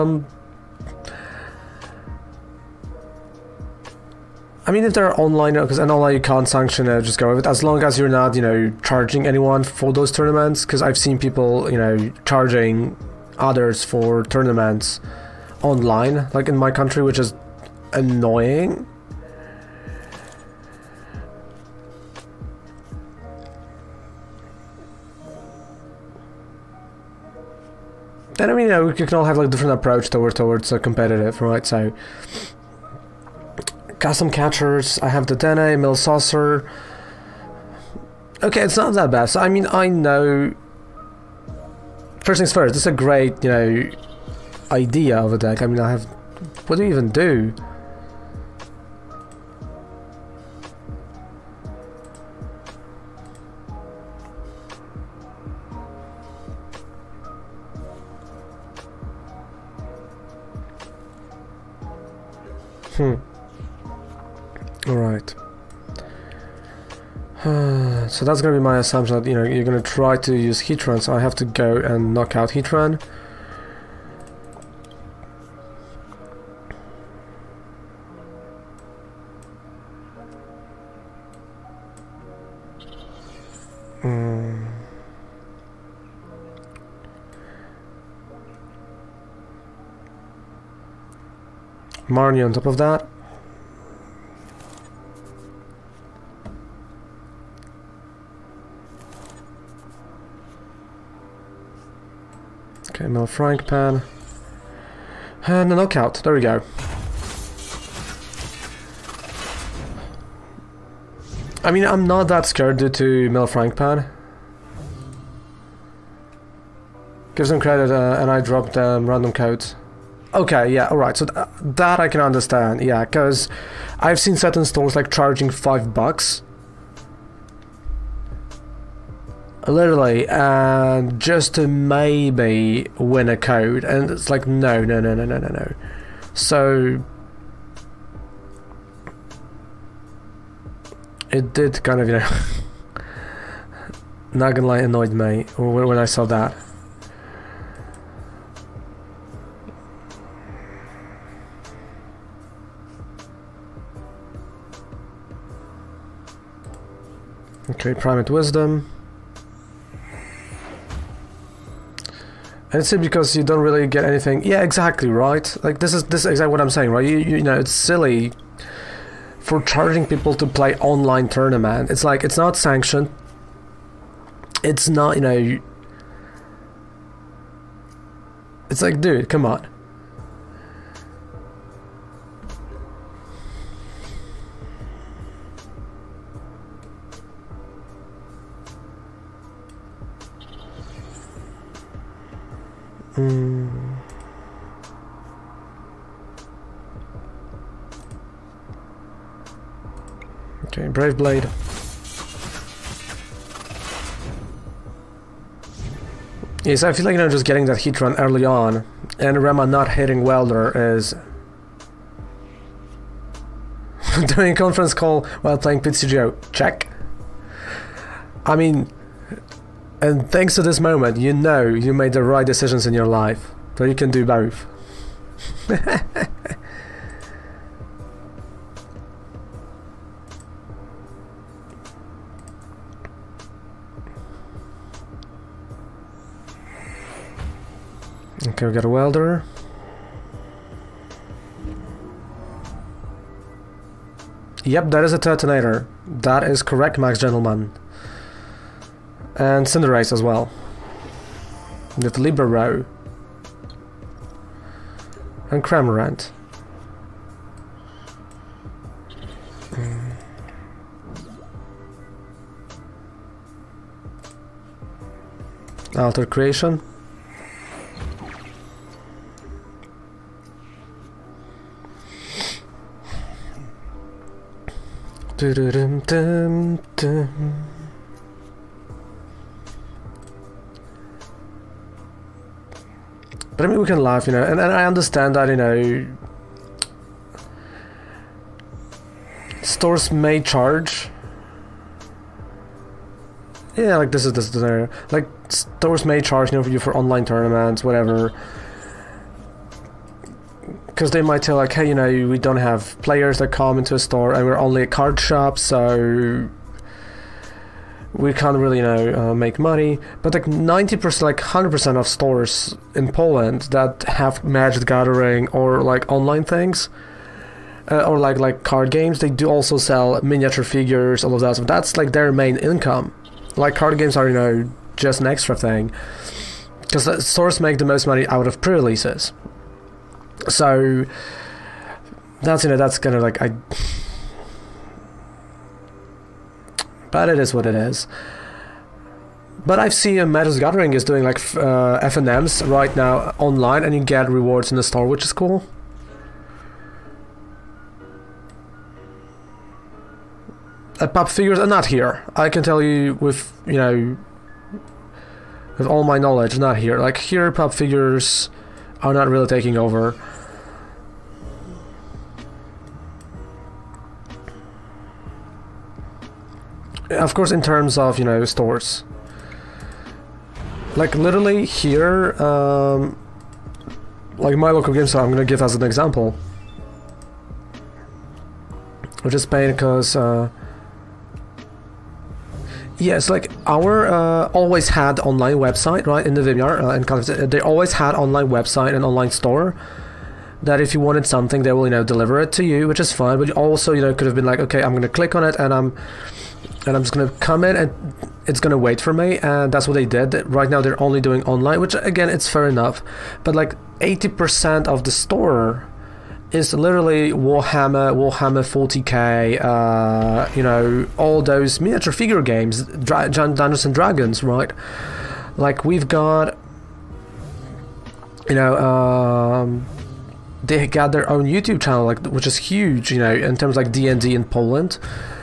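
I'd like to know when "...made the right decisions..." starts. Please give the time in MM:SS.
03:41.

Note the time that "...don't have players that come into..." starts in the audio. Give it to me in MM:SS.
05:02.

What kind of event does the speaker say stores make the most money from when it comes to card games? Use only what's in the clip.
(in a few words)
Pre-releases.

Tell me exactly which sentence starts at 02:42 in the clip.
And it's because you don't really get anything.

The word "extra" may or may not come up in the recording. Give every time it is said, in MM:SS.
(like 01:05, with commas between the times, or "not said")
05:25.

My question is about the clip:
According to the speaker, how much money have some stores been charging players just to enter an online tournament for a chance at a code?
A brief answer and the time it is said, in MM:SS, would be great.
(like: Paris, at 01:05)
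5 bucks, at 02:05.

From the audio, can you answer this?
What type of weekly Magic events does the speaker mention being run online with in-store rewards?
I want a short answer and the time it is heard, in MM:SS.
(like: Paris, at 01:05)
FNMs, at 05:42.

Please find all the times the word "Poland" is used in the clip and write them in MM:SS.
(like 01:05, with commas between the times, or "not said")
05:13, 07:04.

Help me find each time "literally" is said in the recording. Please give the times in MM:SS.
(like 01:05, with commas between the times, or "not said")
02:09, 06:11, 06:46.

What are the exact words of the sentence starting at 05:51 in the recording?
Uh, pop figures are not here.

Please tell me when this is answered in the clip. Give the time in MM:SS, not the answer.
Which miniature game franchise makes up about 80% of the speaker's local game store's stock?
06:48.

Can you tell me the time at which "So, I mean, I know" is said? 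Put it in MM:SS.
00:39.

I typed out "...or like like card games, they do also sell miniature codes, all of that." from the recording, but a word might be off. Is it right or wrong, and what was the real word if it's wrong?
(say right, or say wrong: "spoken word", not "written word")
wrong: "figures", not "codes".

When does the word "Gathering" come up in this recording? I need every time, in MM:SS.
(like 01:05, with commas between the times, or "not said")
05:14, 05:40.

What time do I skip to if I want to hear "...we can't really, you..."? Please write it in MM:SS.
05:08.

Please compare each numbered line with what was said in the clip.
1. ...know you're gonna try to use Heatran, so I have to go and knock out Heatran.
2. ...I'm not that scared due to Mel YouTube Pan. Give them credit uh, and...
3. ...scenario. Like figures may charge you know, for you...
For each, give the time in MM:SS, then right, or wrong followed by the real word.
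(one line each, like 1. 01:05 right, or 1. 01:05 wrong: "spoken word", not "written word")
1. 01:09 right
2. 01:51 wrong: "Frank", not "YouTube"
3. 04:54 wrong: "stores", not "figures".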